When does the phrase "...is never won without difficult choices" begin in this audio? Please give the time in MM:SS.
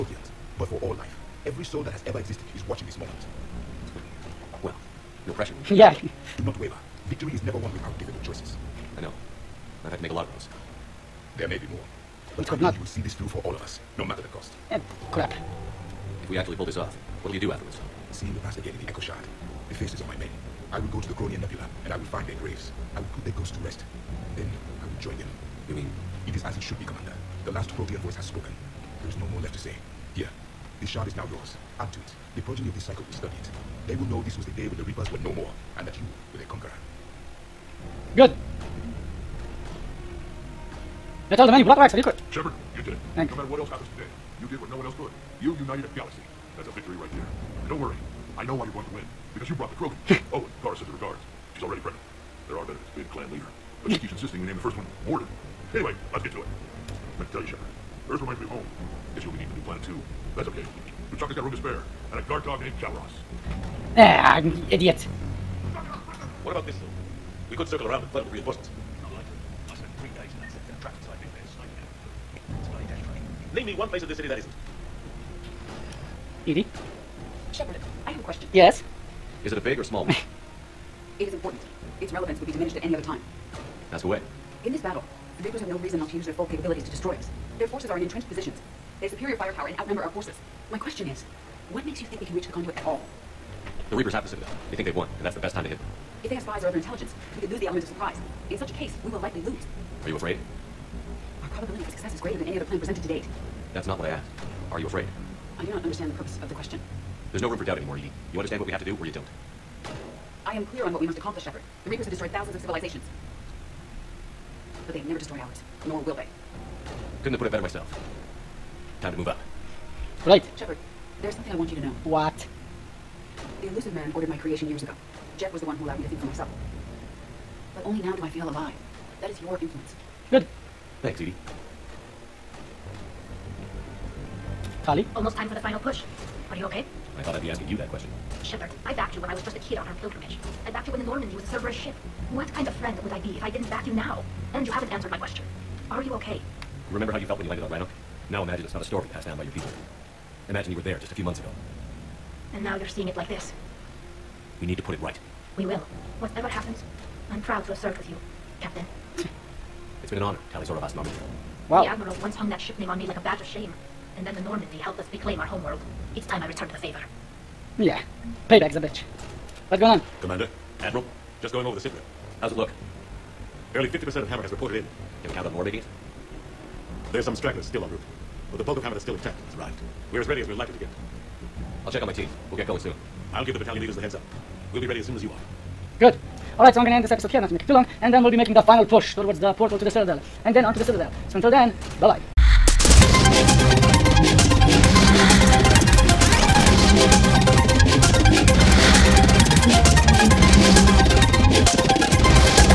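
00:07.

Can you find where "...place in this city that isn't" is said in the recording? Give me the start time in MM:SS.
01:13.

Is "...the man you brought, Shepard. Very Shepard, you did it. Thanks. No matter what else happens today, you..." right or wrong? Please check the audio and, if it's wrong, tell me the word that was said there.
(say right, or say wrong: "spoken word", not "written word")
wrong: "Wrex", not "Shepard".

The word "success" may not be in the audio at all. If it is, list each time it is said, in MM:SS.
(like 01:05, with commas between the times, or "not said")
01:41.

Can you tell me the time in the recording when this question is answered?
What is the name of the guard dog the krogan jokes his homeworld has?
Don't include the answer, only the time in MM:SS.
01:02.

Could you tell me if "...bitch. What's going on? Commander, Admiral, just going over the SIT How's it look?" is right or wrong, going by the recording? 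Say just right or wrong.
right.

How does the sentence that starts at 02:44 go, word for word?
And then the Normandy helped us reclaim our homeworld.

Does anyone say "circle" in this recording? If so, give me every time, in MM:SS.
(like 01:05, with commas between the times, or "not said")
01:07.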